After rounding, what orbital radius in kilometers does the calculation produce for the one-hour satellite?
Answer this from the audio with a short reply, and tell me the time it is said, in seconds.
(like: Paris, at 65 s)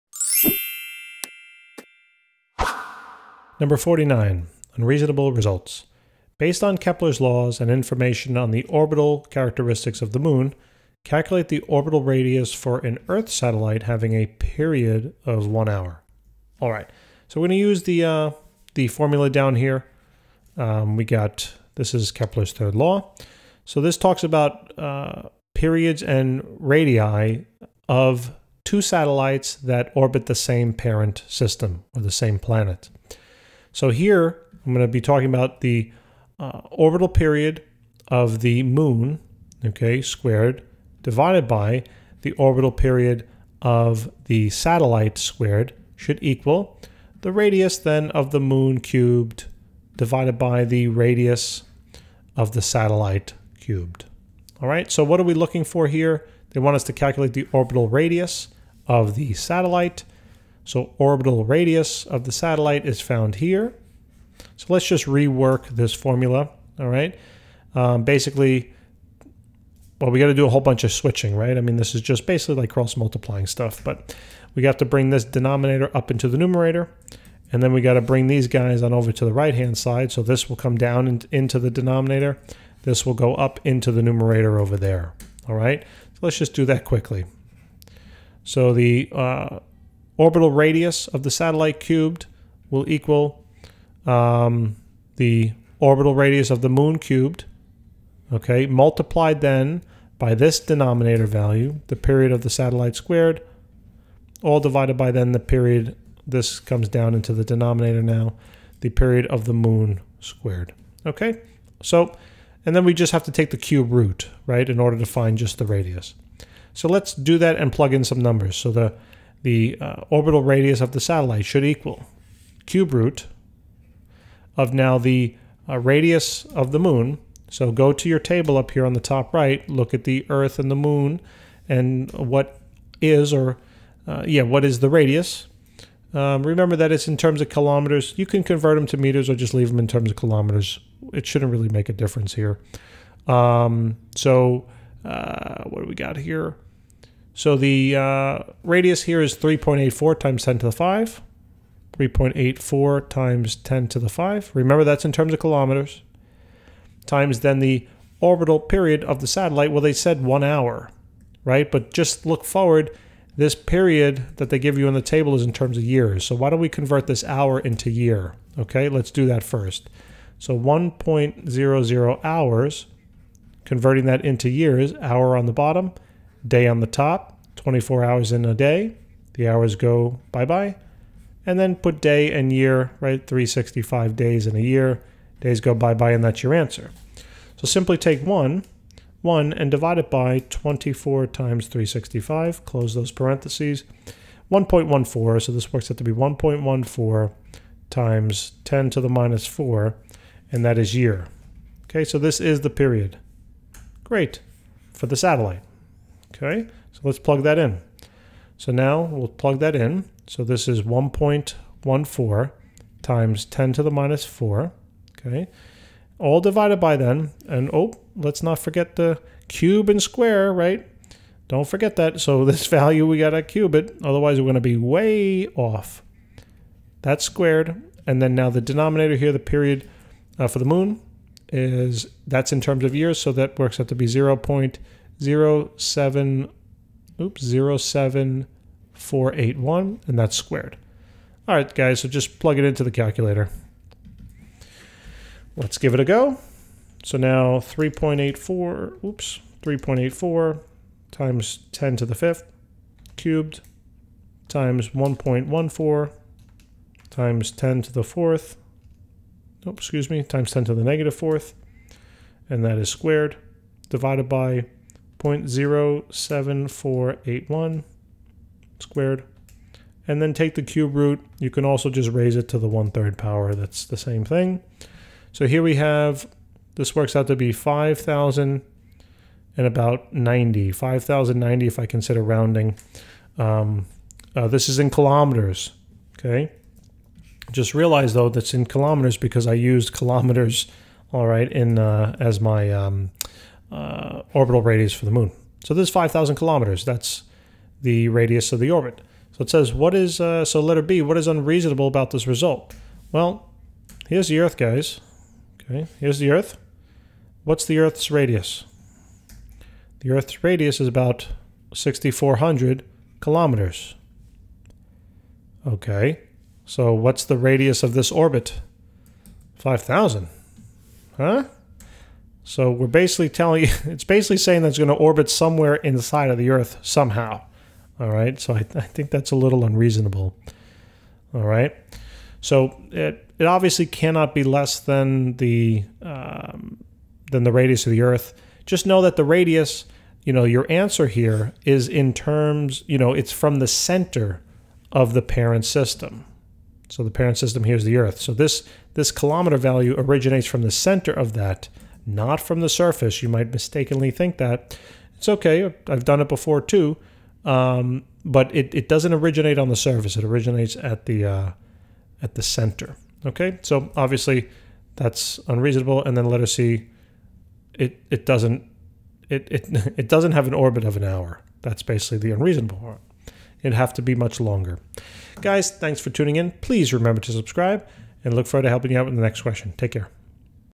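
5,090, at 280 s.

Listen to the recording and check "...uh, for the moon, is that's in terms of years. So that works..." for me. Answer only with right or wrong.
right.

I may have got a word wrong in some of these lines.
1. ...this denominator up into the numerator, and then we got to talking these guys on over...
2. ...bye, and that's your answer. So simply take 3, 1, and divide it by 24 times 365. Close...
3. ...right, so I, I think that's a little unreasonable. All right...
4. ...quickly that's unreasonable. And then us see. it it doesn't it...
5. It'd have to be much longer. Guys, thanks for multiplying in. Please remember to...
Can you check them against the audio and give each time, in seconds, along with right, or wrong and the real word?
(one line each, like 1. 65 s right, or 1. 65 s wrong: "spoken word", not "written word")
1. 75 s wrong: "bring", not "talking"
2. 185 s wrong: "1", not "3"
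3. 328 s right
4. 363 s wrong: "obviously", not "quickly"
5. 373 s wrong: "tuning", not "multiplying".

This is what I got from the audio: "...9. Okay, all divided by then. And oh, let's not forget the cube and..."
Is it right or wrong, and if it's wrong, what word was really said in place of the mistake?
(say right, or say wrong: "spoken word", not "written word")
wrong: "4", not "9".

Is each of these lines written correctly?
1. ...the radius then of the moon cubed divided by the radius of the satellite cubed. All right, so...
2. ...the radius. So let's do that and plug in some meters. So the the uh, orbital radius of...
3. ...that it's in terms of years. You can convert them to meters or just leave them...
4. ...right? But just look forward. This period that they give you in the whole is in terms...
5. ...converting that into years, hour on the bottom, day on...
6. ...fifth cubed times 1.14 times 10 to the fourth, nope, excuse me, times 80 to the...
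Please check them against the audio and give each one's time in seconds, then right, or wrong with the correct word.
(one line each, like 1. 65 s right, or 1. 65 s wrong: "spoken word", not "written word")
1. 47 s right
2. 115 s wrong: "numbers", not "meters"
3. 136 s wrong: "kilometers", not "years"
4. 161 s wrong: "table", not "whole"
5. 173 s right
6. 252 s wrong: "10", not "80".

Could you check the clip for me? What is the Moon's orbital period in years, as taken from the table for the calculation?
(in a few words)
0.07481.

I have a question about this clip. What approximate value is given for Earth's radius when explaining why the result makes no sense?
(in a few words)
6,400 kilometers.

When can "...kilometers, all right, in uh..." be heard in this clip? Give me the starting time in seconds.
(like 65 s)
289 s.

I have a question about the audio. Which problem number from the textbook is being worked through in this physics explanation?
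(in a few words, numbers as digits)
49.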